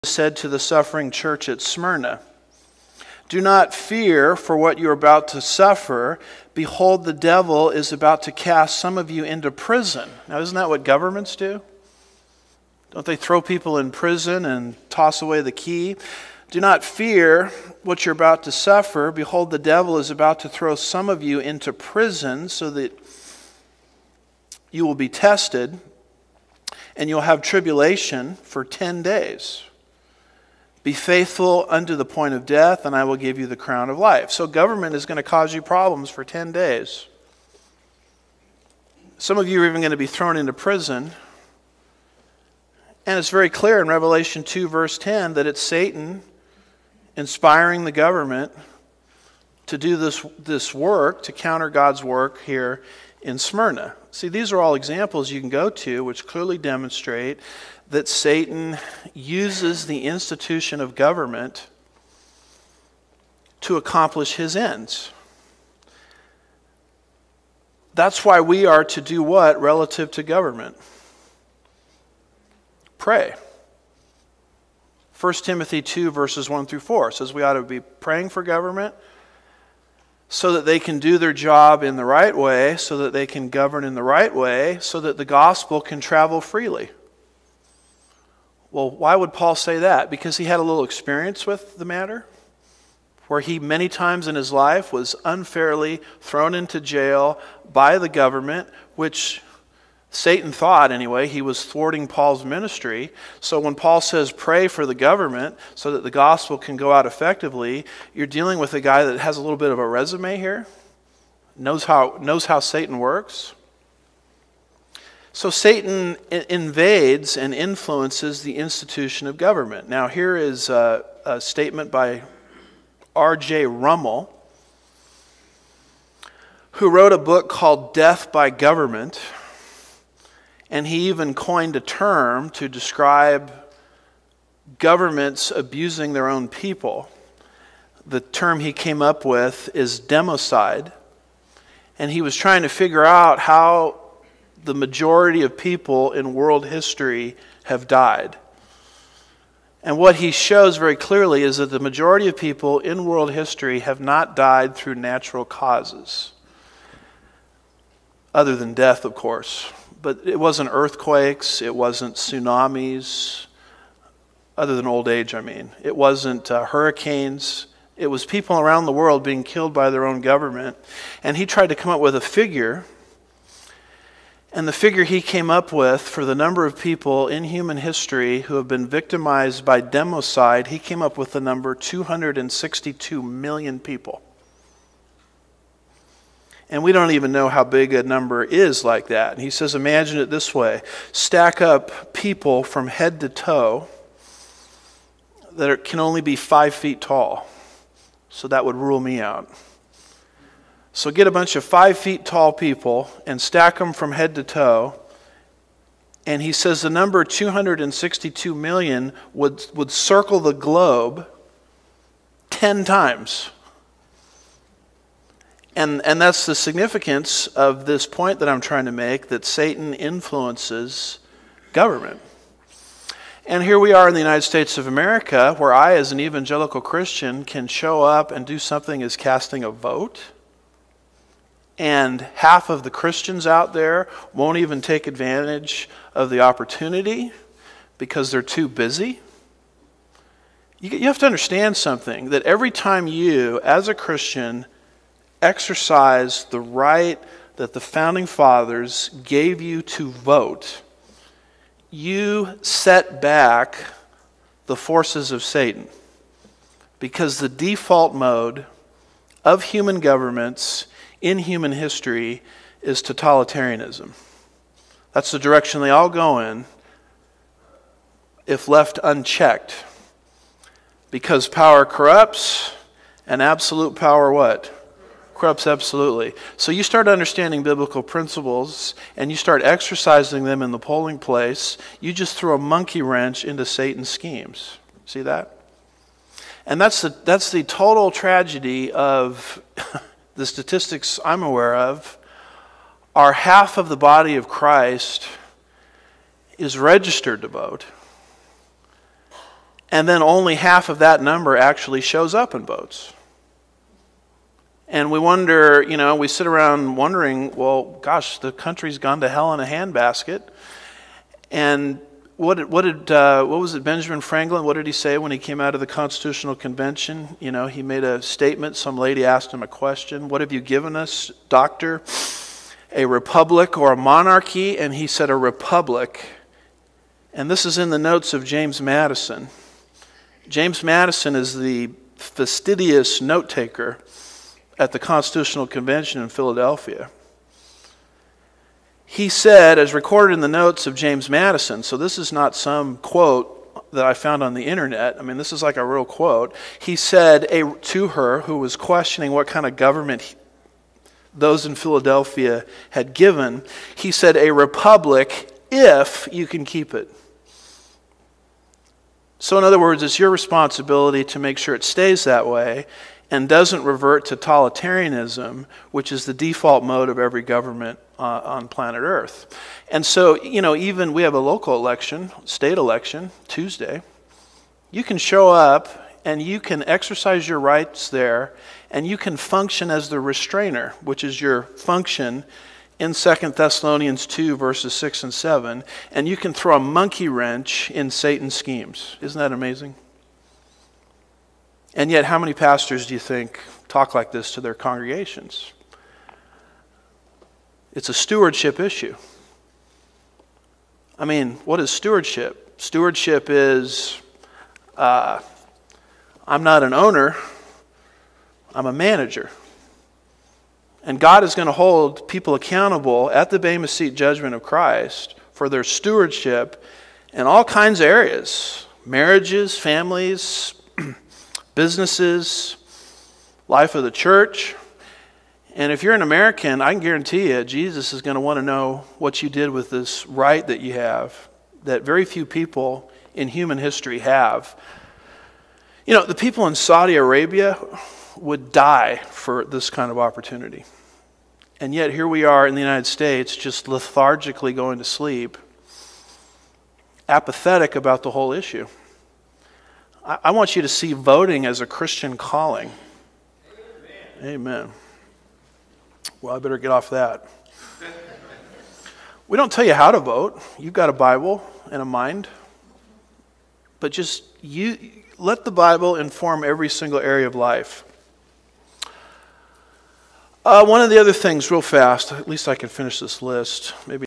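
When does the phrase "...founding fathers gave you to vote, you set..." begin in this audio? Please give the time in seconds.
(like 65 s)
247 s.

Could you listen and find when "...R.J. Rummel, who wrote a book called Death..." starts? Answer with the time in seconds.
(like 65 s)
123 s.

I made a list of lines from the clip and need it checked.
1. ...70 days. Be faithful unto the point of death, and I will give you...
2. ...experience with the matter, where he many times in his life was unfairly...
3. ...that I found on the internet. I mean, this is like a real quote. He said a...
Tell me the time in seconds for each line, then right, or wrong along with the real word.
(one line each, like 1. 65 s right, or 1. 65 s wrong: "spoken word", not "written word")
1. 28 s wrong: "10", not "70"
2. 90 s right
3. 343 s right.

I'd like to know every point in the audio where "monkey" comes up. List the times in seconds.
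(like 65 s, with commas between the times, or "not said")
282 s, 386 s.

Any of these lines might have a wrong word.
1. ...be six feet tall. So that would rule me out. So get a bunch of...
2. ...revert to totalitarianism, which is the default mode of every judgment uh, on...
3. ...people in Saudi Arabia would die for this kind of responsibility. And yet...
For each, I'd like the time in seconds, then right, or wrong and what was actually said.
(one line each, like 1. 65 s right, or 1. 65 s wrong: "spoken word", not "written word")
1. 196 s wrong: "five", not "six"
2. 363 s wrong: "government", not "judgment"
3. 436 s wrong: "opportunity", not "responsibility".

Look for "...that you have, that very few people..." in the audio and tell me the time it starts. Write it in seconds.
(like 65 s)
430 s.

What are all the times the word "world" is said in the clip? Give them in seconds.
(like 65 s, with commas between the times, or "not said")
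146 s, 153 s, 168 s.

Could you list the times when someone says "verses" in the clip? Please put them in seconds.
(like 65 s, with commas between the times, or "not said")
44 s, 76 s, 384 s.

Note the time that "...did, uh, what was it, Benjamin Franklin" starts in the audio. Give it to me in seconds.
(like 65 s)
312 s.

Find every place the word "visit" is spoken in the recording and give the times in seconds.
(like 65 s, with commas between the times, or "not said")
not said.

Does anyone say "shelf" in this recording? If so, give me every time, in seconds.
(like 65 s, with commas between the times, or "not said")
not said.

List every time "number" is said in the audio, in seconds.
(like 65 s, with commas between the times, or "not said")
176 s, 181 s, 188 s, 206 s, 301 s.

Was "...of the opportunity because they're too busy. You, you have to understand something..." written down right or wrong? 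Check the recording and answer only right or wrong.
right.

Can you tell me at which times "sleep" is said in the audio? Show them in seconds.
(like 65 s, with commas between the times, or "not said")
445 s.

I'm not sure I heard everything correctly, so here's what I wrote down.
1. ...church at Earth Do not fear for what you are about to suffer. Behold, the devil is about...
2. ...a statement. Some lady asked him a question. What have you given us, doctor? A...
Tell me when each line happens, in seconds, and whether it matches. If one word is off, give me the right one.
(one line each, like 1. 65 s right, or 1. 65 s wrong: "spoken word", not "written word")
1. 1 s wrong: "Smyrna", not "Earth"
2. 318 s right.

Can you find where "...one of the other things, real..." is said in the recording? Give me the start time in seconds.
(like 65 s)
470 s.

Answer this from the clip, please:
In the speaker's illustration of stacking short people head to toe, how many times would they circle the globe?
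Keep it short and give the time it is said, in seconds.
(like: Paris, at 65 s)
10, at 212 s.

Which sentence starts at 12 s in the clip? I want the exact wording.
Don't they throw people in prison and toss away the key?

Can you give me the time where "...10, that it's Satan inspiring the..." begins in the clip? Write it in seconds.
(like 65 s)
44 s.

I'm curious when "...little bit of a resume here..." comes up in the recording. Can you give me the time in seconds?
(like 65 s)
109 s.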